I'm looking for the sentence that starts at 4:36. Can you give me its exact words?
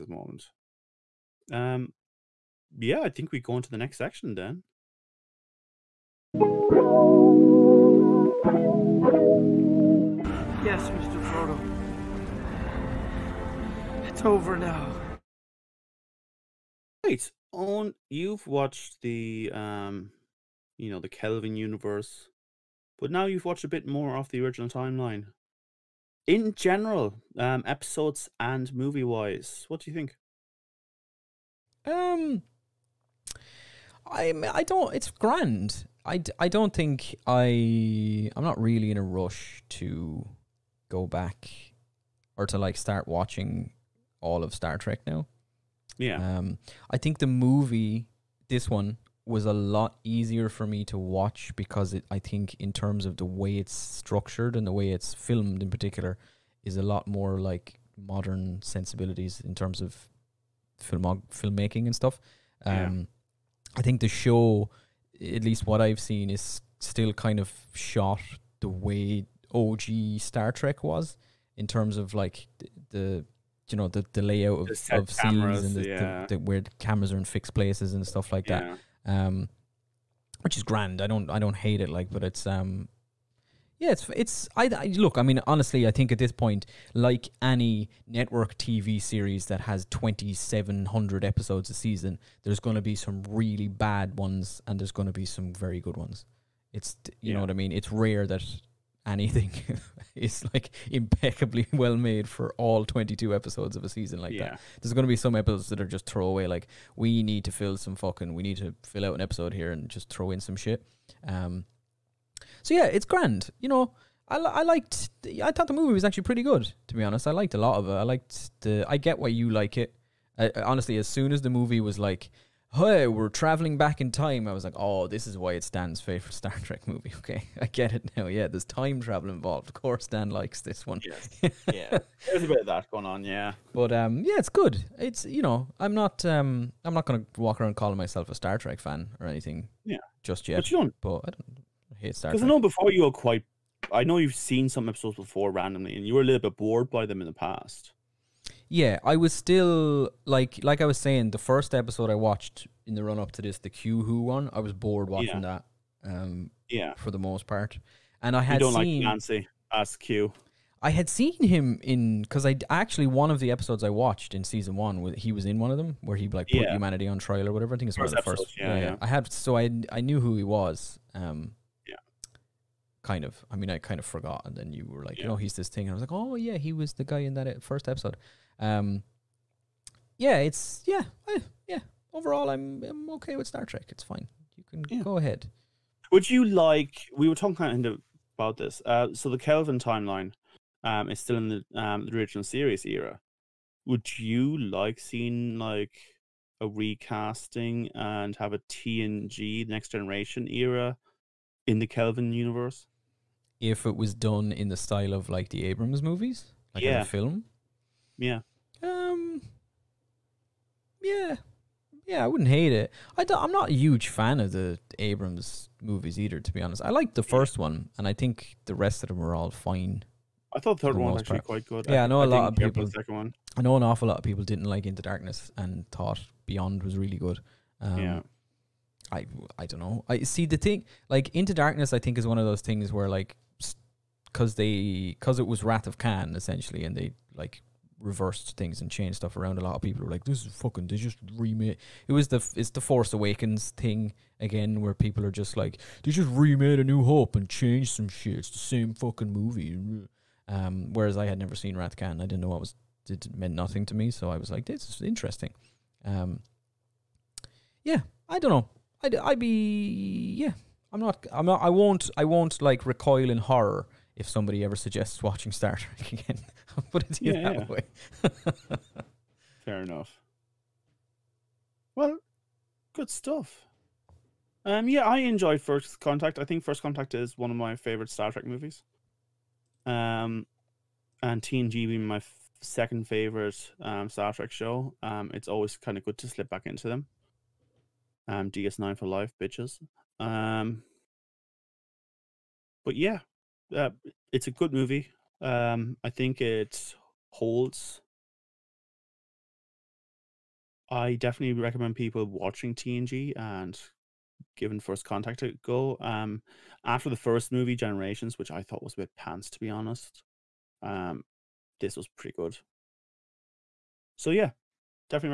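I think First Contact is one of my favorite Star Trek movies.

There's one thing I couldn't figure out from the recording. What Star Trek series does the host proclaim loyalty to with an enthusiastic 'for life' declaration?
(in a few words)
DS9.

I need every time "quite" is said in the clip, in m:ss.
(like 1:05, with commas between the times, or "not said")
2:23, 3:41.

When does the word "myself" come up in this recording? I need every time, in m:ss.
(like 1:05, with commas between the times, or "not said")
2:17.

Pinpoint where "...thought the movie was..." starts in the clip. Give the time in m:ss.
1:55.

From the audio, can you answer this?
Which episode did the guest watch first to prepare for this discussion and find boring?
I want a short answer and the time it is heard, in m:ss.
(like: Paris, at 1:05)
Q Who, at 2:33.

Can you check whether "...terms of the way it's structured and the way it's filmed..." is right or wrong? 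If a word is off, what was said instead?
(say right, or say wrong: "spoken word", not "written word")
right.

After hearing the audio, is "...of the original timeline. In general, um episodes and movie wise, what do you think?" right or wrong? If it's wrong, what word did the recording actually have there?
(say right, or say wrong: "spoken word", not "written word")
right.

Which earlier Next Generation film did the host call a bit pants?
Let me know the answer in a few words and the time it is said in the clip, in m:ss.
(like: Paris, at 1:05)
Generations, at 5:07.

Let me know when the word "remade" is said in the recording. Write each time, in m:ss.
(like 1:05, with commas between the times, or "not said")
4:01, 4:06.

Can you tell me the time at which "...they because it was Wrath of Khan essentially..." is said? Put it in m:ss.
3:54.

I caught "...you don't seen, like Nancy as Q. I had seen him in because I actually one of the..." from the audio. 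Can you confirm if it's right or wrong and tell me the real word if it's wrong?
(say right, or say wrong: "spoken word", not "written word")
right.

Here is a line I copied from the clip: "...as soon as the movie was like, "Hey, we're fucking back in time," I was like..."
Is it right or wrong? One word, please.
wrong.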